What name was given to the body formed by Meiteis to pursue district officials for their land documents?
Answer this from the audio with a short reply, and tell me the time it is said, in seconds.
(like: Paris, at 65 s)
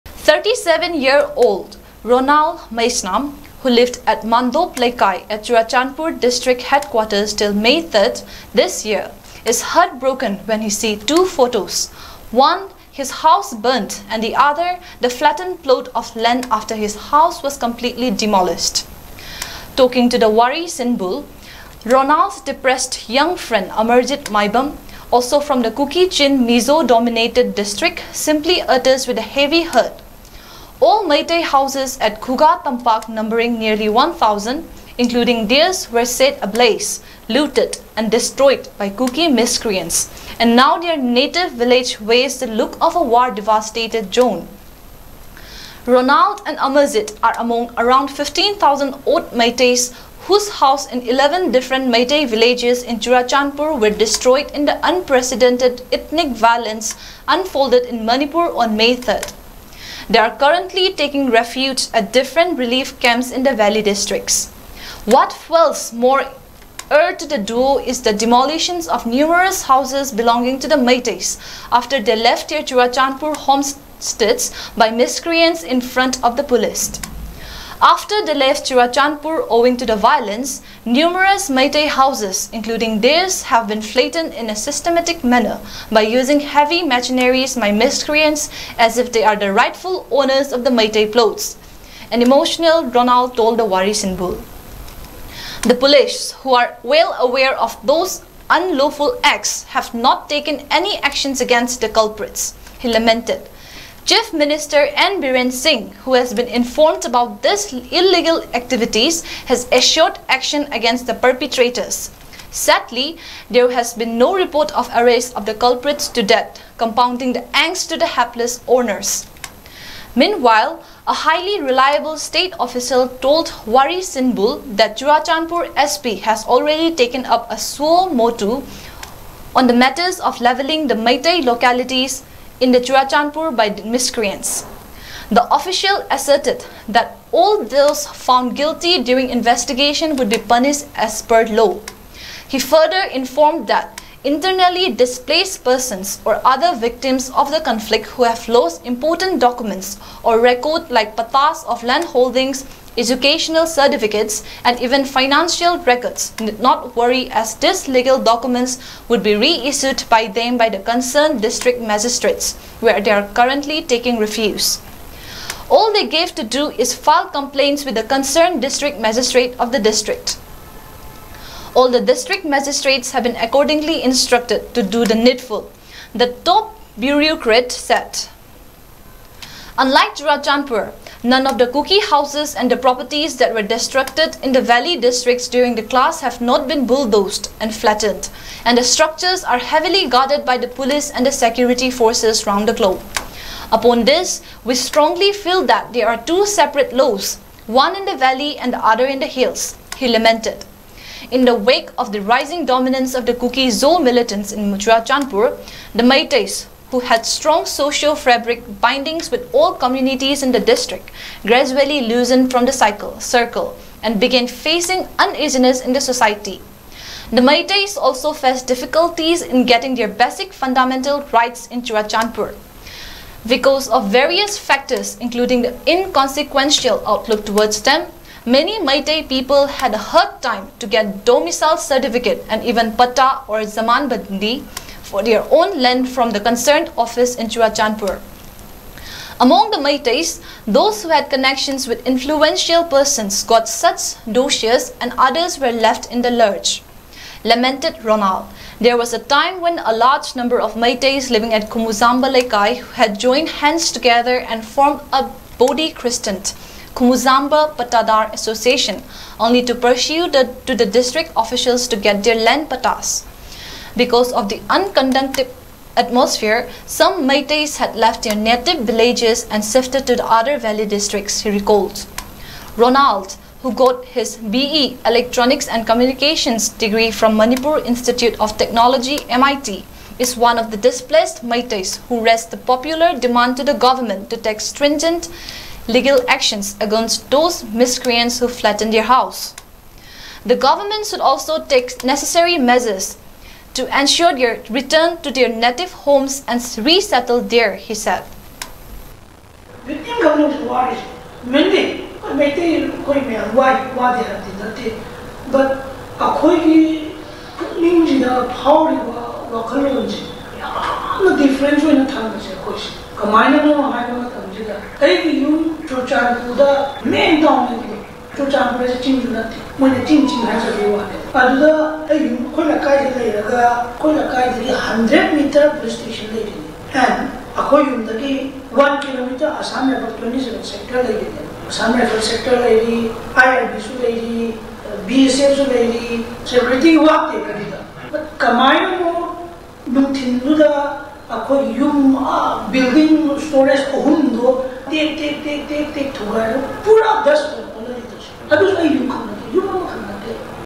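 Kumuzamba Patadar Association, at 256 s.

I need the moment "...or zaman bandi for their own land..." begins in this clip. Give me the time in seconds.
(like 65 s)
233 s.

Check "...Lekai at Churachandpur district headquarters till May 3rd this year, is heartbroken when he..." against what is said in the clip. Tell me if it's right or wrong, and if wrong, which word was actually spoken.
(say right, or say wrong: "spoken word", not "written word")
right.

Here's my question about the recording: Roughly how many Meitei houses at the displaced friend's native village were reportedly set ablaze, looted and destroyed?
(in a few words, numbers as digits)
1,000.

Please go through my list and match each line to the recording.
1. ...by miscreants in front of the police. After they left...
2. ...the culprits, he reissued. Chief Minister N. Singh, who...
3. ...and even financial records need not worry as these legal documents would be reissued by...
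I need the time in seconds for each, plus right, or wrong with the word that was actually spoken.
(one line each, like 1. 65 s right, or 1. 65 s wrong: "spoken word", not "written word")
1. 74 s right
2. 101 s wrong: "lamented", not "reissued"
3. 154 s right.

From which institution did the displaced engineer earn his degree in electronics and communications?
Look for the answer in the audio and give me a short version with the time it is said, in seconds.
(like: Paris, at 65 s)
Manipur Institute of Technology, at 277 s.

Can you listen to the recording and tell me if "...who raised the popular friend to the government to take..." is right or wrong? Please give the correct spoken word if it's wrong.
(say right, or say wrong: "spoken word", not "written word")
wrong: "demand", not "friend".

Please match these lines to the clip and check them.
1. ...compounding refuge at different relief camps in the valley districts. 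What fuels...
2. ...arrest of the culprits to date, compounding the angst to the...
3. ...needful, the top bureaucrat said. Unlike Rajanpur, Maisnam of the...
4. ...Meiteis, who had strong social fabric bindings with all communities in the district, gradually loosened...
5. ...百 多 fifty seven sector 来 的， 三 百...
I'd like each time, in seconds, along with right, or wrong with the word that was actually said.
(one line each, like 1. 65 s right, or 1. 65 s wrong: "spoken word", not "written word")
1. 60 s wrong: "taking", not "compounding"
2. 114 s right
3. 175 s wrong: "None", not "Maisnam"
4. 206 s right
5. 329 s wrong: "twenty", not "fifty".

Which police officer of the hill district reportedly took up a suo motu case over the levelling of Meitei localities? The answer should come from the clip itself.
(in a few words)
Churachandpur SP.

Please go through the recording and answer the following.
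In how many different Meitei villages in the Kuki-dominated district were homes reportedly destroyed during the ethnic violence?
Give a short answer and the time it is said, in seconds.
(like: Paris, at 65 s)
11, at 51 s.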